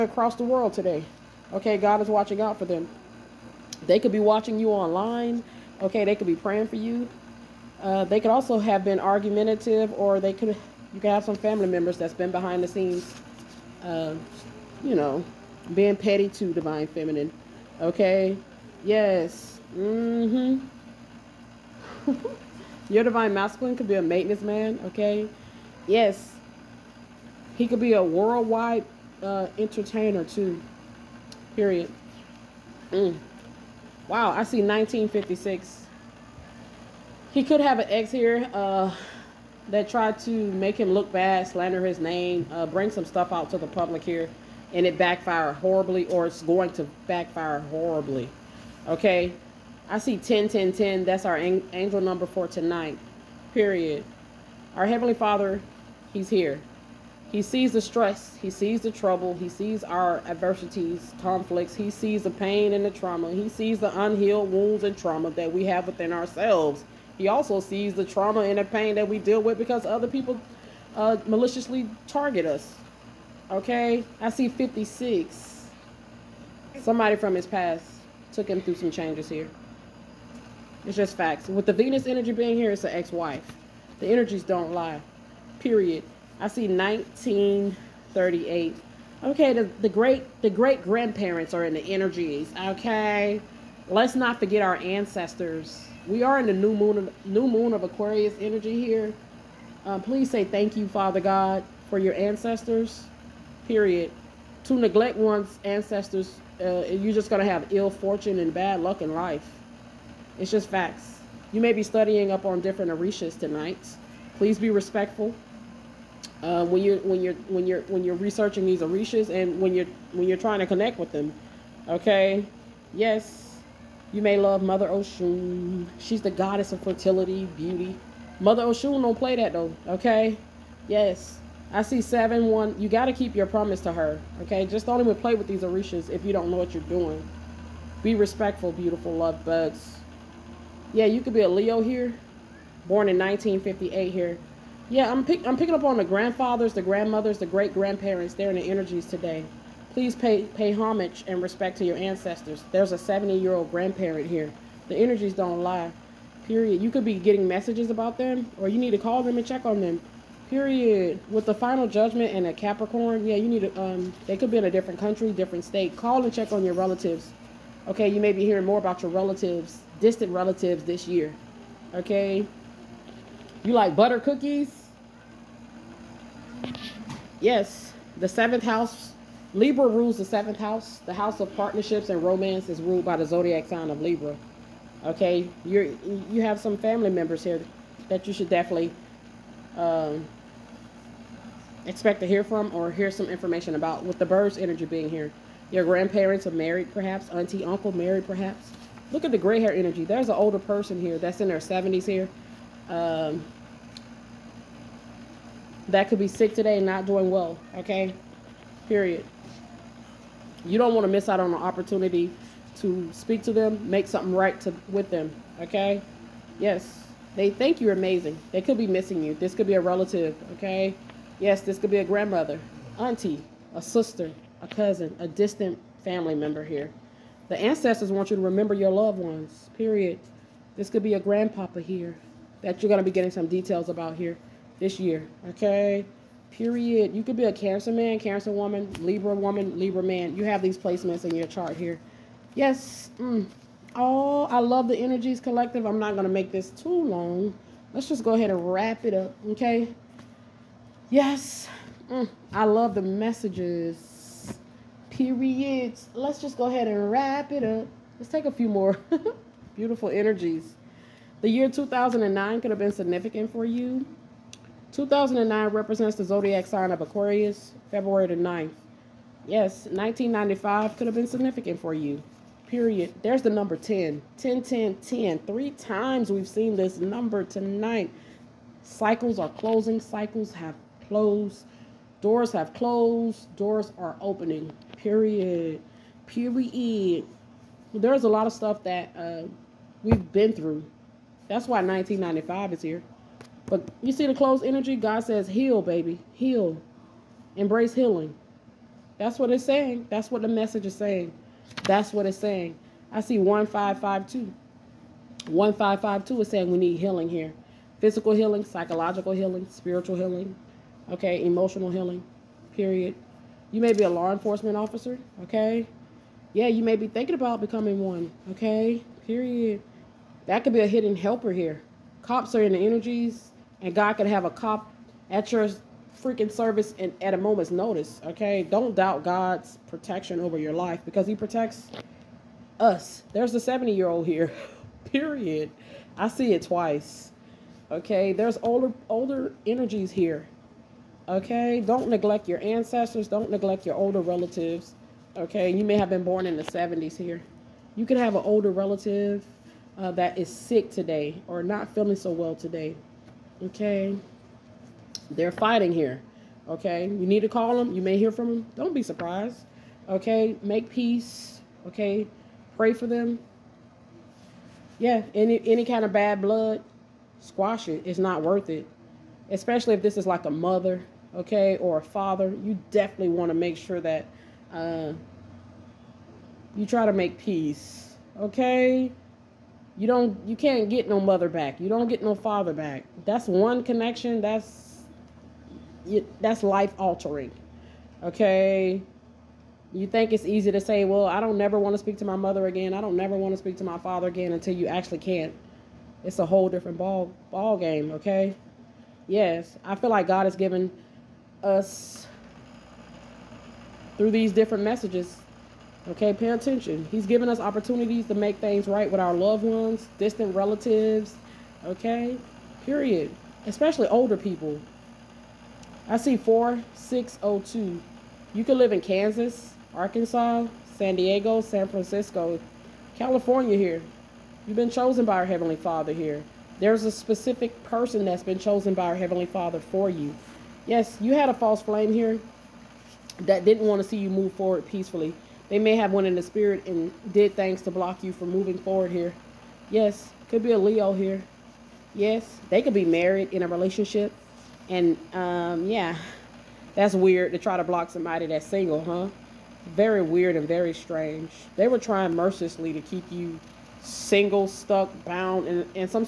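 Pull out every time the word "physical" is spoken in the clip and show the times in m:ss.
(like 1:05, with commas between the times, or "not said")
5:08.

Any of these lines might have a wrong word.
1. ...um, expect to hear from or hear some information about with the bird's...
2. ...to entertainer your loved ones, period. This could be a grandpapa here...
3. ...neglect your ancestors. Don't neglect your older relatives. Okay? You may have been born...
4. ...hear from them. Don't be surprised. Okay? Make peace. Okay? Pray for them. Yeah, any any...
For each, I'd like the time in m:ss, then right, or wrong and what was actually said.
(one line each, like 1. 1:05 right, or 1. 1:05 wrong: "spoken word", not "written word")
1. 3:09 right
2. 3:48 wrong: "remember", not "entertainer"
3. 5:42 right
4. 5:58 right.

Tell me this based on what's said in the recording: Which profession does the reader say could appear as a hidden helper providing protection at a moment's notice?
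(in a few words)
Law enforcement officer.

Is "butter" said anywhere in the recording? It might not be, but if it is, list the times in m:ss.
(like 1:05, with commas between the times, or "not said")
2:53.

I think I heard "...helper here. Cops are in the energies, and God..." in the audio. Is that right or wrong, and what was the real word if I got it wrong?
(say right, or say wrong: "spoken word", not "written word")
right.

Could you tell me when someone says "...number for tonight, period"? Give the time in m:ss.
0:52.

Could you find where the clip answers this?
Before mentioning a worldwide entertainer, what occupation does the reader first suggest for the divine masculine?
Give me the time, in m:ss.
0:24.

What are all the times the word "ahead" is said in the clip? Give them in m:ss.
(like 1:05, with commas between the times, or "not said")
4:08, 4:16.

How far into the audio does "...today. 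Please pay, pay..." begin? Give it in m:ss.
2:29.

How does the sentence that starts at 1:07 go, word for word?
He also sees the trauma and the pain that we deal with because other people uh, maliciously target us.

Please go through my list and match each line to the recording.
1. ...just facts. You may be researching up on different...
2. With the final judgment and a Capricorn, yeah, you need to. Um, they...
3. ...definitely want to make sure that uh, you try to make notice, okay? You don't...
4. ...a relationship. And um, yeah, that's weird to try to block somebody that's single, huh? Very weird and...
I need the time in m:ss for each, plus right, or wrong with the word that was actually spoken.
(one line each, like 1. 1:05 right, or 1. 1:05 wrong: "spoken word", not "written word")
1. 1:50 wrong: "studying", not "researching"
2. 2:41 right
3. 6:12 wrong: "peace", not "notice"
4. 7:23 right.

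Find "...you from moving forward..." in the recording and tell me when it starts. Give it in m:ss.
7:18.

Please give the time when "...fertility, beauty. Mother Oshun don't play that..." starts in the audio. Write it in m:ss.
2:06.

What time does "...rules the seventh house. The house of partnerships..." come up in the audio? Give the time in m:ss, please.
2:59.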